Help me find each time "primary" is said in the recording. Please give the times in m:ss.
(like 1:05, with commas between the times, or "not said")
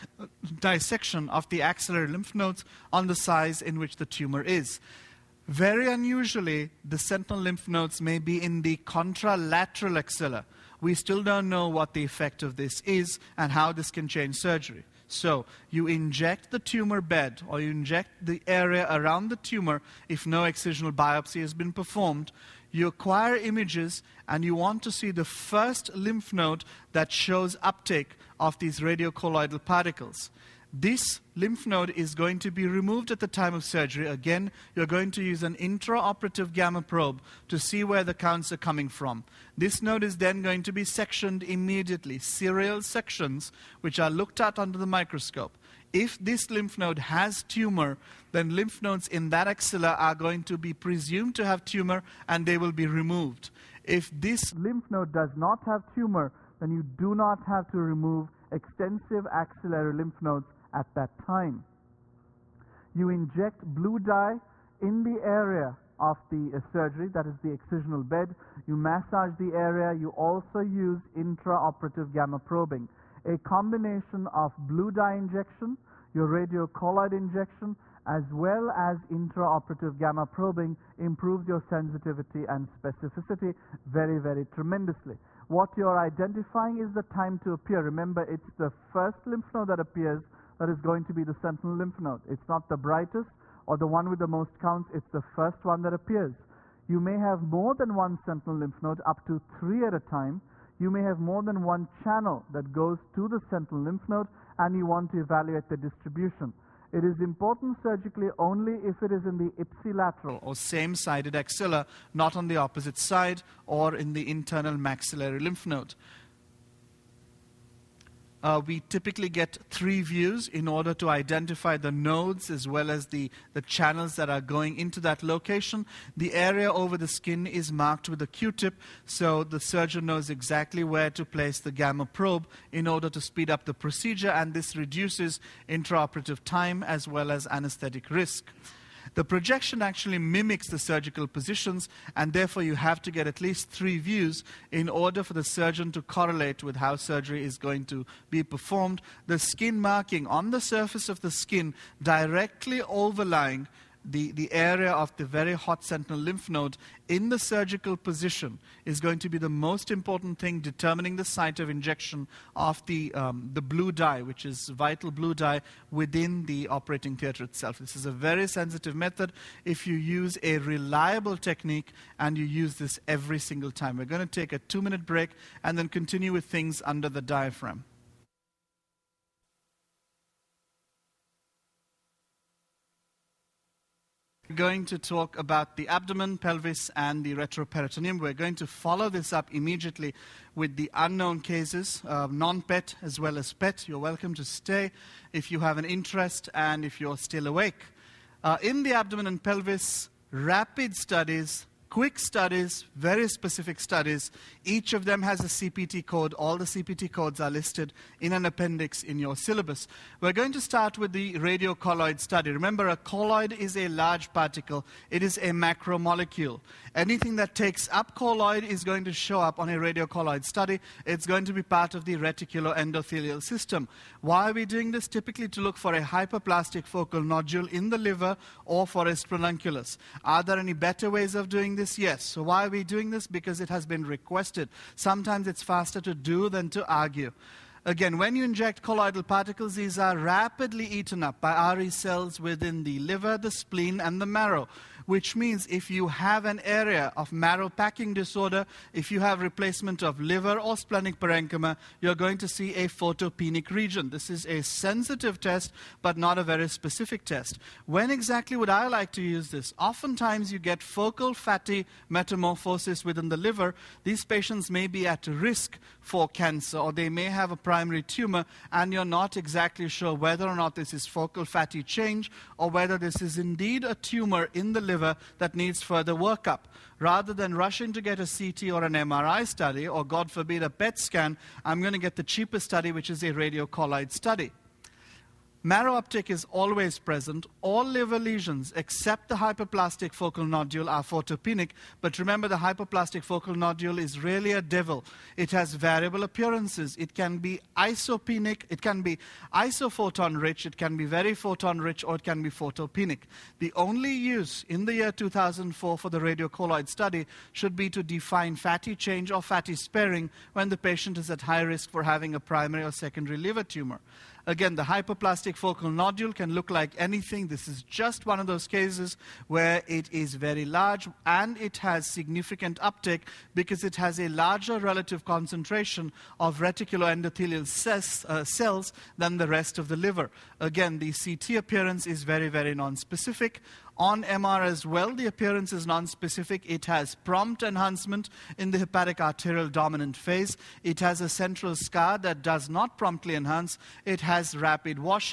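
4:27, 5:12.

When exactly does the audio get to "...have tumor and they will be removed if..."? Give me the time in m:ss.
0:51.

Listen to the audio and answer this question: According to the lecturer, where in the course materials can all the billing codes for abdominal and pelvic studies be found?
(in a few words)
an appendix.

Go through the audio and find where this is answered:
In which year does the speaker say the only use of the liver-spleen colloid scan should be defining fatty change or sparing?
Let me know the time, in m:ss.
5:05.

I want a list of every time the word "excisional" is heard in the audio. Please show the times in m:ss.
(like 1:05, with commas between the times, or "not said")
0:20, 1:07.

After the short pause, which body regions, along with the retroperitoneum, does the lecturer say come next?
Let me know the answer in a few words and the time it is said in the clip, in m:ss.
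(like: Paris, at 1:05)
abdomen and pelvis, at 3:05.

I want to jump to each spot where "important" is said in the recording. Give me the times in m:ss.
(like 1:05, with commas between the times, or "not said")
1:47, 2:39.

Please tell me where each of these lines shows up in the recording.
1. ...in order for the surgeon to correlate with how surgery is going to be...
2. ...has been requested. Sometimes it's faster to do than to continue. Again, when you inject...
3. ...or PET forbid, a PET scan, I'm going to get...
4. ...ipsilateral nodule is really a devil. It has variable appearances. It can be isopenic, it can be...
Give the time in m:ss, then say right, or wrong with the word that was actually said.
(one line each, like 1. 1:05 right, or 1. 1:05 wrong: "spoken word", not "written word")
1. 2:24 right
2. 3:53 wrong: "argue", not "continue"
3. 4:39 wrong: "God", not "PET"
4. 4:53 wrong: "focal", not "ipsilateral".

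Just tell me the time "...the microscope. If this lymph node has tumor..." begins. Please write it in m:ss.
0:44.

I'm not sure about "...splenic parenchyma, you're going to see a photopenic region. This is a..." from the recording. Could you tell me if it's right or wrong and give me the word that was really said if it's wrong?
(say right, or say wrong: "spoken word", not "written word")
right.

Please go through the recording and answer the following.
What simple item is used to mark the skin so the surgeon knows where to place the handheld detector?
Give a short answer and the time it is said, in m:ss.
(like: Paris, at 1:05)
Q-tip, at 2:08.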